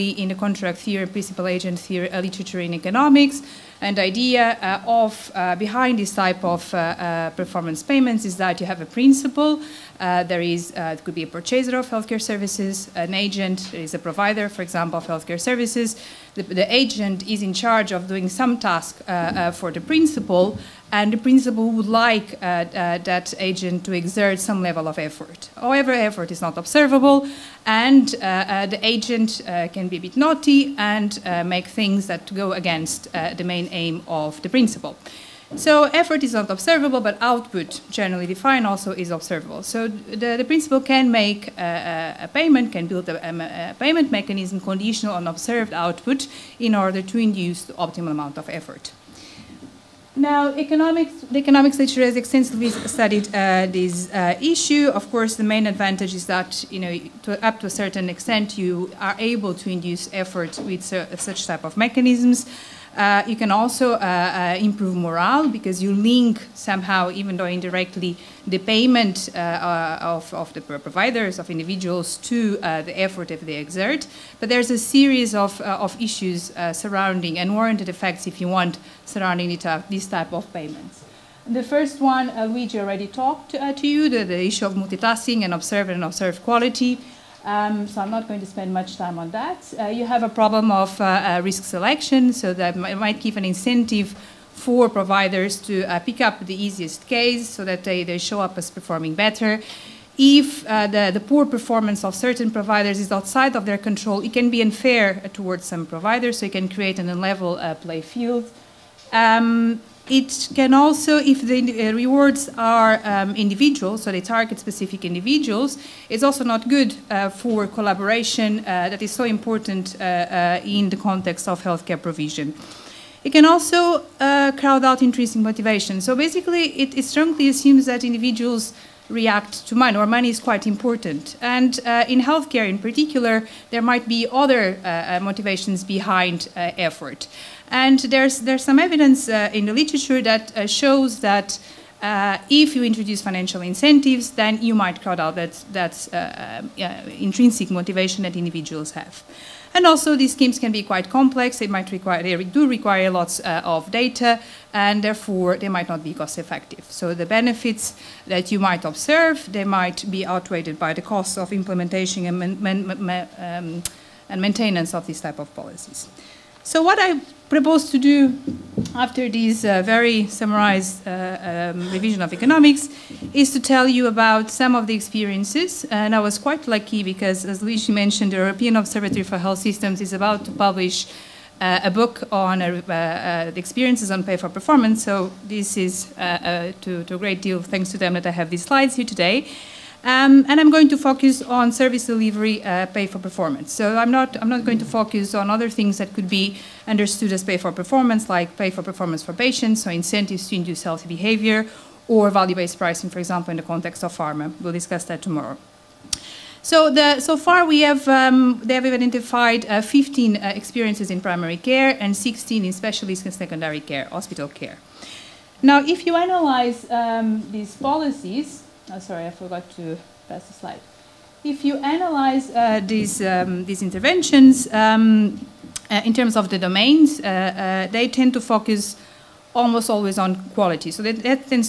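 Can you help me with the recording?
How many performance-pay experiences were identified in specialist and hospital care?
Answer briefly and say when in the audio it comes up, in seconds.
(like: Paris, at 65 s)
16, at 212 s.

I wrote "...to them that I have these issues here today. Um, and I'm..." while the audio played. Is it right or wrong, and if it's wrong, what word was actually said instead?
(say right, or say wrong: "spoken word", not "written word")
wrong: "slides", not "issues".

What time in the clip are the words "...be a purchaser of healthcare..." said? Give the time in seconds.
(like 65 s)
11 s.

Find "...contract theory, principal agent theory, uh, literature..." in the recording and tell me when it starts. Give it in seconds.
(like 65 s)
0 s.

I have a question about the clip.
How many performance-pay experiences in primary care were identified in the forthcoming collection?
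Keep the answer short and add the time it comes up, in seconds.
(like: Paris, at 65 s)
15, at 209 s.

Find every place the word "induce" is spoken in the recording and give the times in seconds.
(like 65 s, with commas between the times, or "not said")
47 s, 59 s, 200 s.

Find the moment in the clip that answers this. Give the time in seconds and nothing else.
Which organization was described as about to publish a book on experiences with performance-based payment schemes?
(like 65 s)
178 s.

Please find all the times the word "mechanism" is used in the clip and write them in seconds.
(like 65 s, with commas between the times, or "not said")
44 s, 61 s.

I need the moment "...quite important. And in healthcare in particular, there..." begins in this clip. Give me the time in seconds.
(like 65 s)
130 s.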